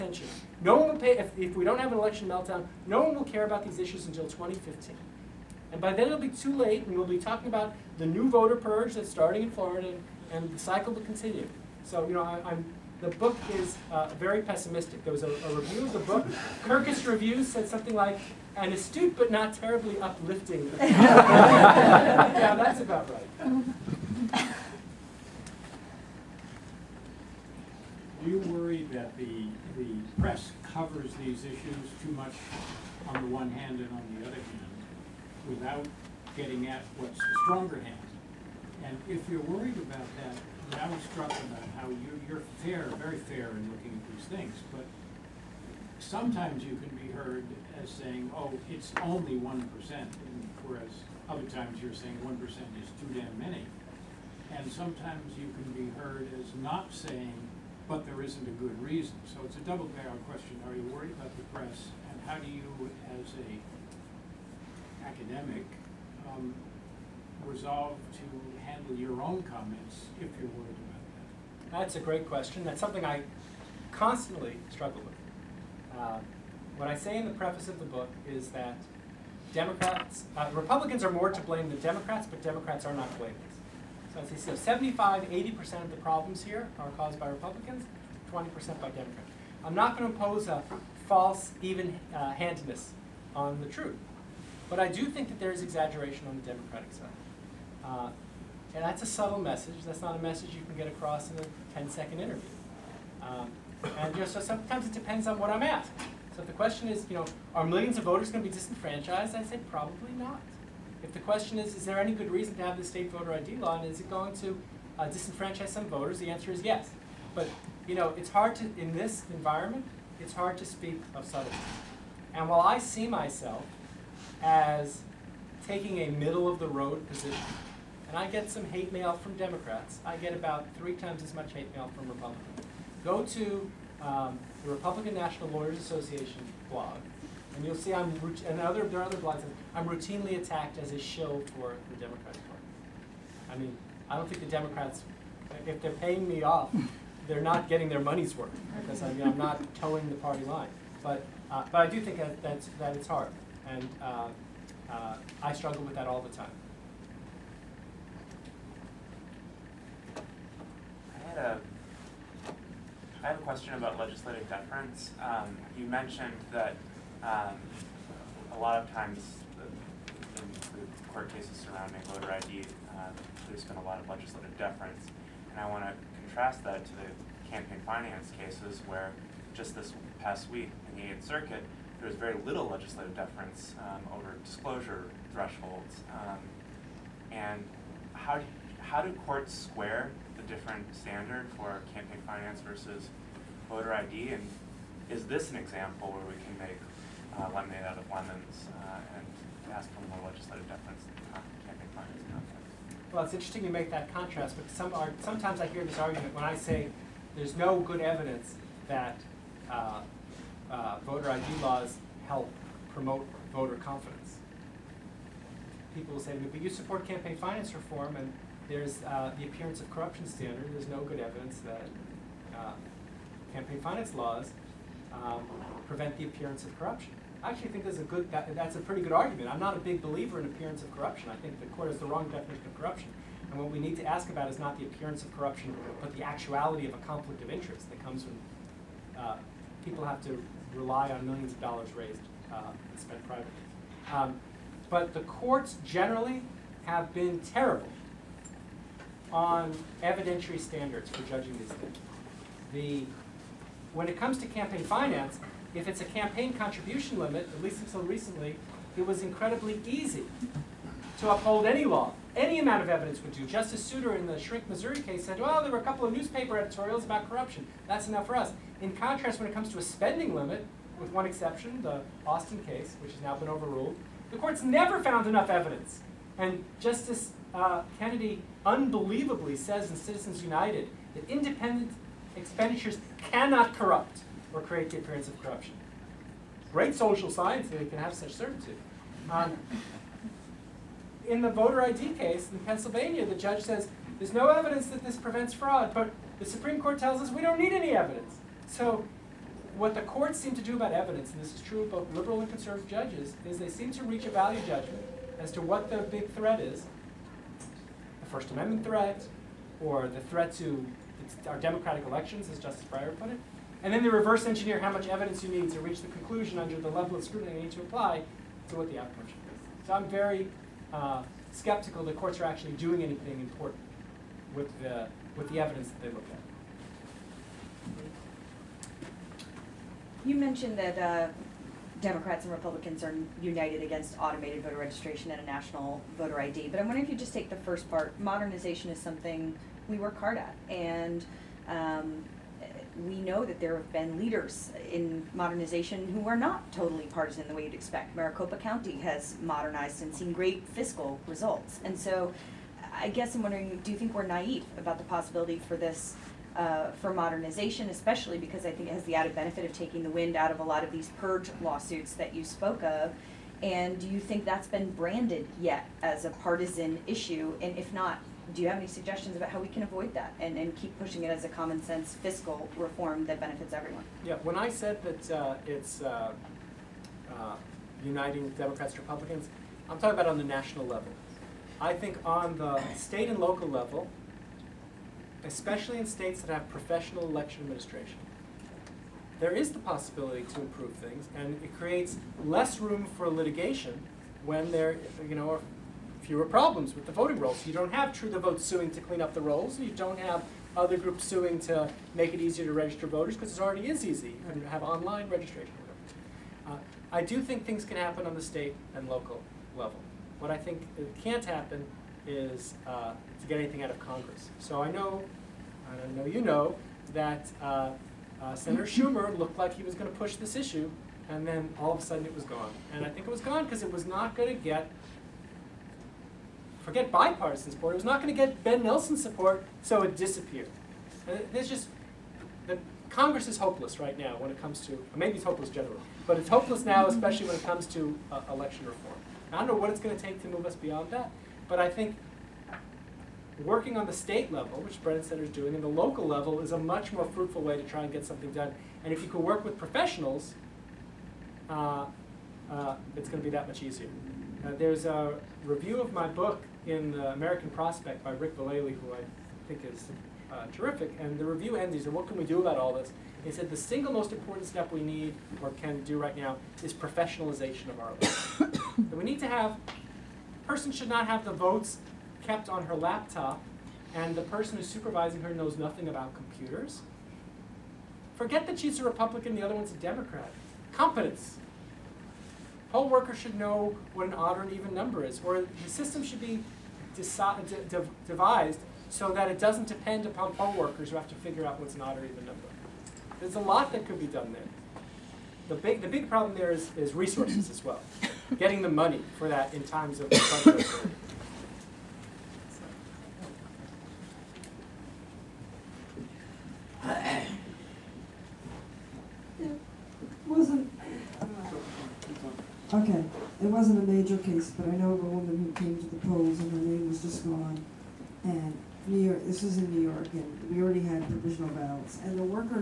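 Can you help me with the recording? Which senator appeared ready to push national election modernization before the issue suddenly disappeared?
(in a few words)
Senator Schumer.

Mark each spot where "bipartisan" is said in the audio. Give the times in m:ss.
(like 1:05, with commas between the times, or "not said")
7:07.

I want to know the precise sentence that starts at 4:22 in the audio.
Any amount of evidence would do.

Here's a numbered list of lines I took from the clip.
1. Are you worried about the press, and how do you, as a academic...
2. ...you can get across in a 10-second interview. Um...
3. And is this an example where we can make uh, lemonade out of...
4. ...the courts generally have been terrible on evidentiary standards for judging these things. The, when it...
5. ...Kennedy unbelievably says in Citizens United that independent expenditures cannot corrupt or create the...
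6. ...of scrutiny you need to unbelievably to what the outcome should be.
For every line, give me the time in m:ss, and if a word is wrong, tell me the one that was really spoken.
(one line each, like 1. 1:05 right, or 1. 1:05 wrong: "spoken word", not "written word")
1. 1:00 right
2. 1:40 right
3. 3:14 right
4. 4:05 right
5. 4:38 right
6. 5:17 wrong: "apply", not "unbelievably".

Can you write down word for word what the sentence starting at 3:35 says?
People will say, but you support campaign finance reform, and there's uh, the appearance of corruption standard.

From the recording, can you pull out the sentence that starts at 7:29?
And if you can work with professionals, uh, uh, it's going to be that much easier.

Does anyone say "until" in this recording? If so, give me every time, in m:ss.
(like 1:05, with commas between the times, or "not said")
0:04, 4:17.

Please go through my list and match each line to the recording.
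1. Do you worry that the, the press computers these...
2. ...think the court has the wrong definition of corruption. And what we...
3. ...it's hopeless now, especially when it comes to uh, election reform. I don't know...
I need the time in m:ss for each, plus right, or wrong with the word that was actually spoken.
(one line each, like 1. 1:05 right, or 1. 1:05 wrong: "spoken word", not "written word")
1. 0:28 wrong: "covers", not "computers"
2. 3:51 right
3. 7:16 right.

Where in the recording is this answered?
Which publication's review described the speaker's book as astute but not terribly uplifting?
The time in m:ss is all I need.
0:16.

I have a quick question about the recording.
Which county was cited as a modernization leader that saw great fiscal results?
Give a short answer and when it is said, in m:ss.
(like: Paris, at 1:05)
Maricopa County, at 5:48.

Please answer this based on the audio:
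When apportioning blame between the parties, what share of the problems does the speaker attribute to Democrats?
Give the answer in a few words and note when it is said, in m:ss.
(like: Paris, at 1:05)
20%, at 1:28.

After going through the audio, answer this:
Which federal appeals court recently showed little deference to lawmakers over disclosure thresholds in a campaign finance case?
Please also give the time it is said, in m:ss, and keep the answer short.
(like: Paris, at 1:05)
Eighth Circuit, at 3:01.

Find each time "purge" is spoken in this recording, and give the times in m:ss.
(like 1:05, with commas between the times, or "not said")
0:08, 6:01.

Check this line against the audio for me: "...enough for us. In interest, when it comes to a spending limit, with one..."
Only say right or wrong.
wrong.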